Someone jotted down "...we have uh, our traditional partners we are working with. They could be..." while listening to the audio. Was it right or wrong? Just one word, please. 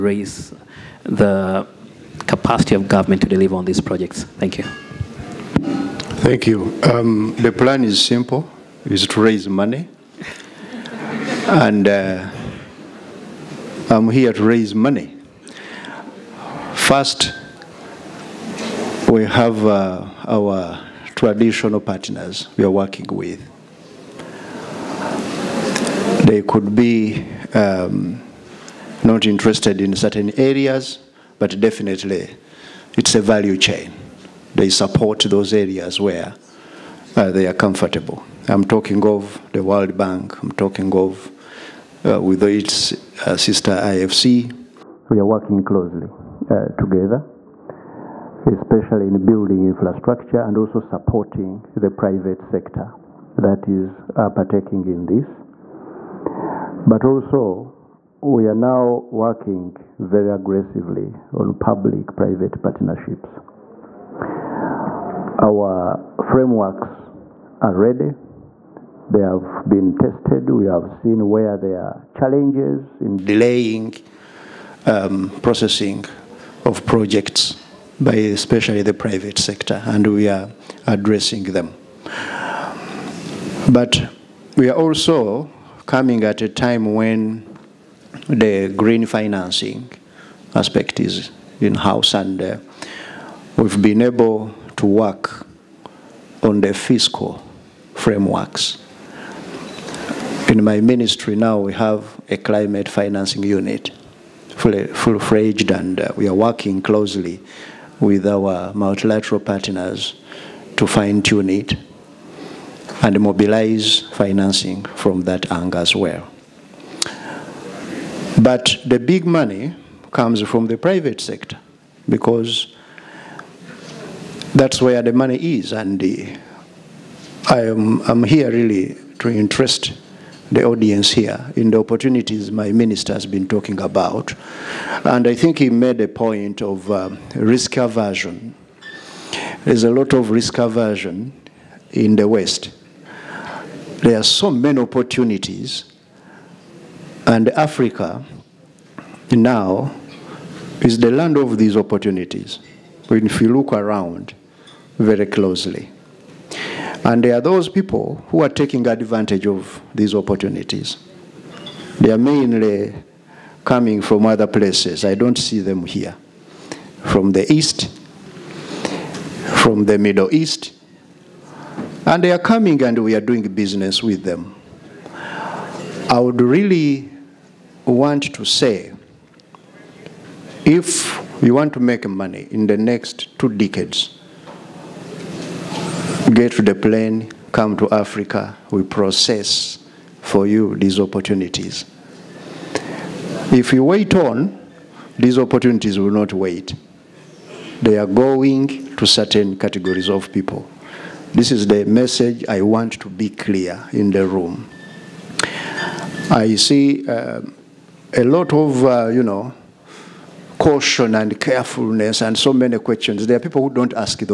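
right.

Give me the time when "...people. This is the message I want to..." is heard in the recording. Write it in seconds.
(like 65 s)
200 s.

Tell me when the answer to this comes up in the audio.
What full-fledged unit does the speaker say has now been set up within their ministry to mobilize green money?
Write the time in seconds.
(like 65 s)
102 s.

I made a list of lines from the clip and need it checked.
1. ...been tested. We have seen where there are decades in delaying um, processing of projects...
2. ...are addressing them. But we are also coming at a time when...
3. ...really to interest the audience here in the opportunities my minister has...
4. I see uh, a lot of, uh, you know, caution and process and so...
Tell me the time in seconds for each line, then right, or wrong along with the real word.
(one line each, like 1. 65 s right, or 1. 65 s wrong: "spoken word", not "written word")
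1. 69 s wrong: "challenges", not "decades"
2. 80 s right
3. 128 s right
4. 206 s wrong: "carefulness", not "process".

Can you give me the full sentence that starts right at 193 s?
If you wait on, these opportunities will not wait.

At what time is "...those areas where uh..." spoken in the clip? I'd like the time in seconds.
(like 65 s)
35 s.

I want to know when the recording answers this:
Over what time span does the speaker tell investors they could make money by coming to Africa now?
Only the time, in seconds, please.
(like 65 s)
183 s.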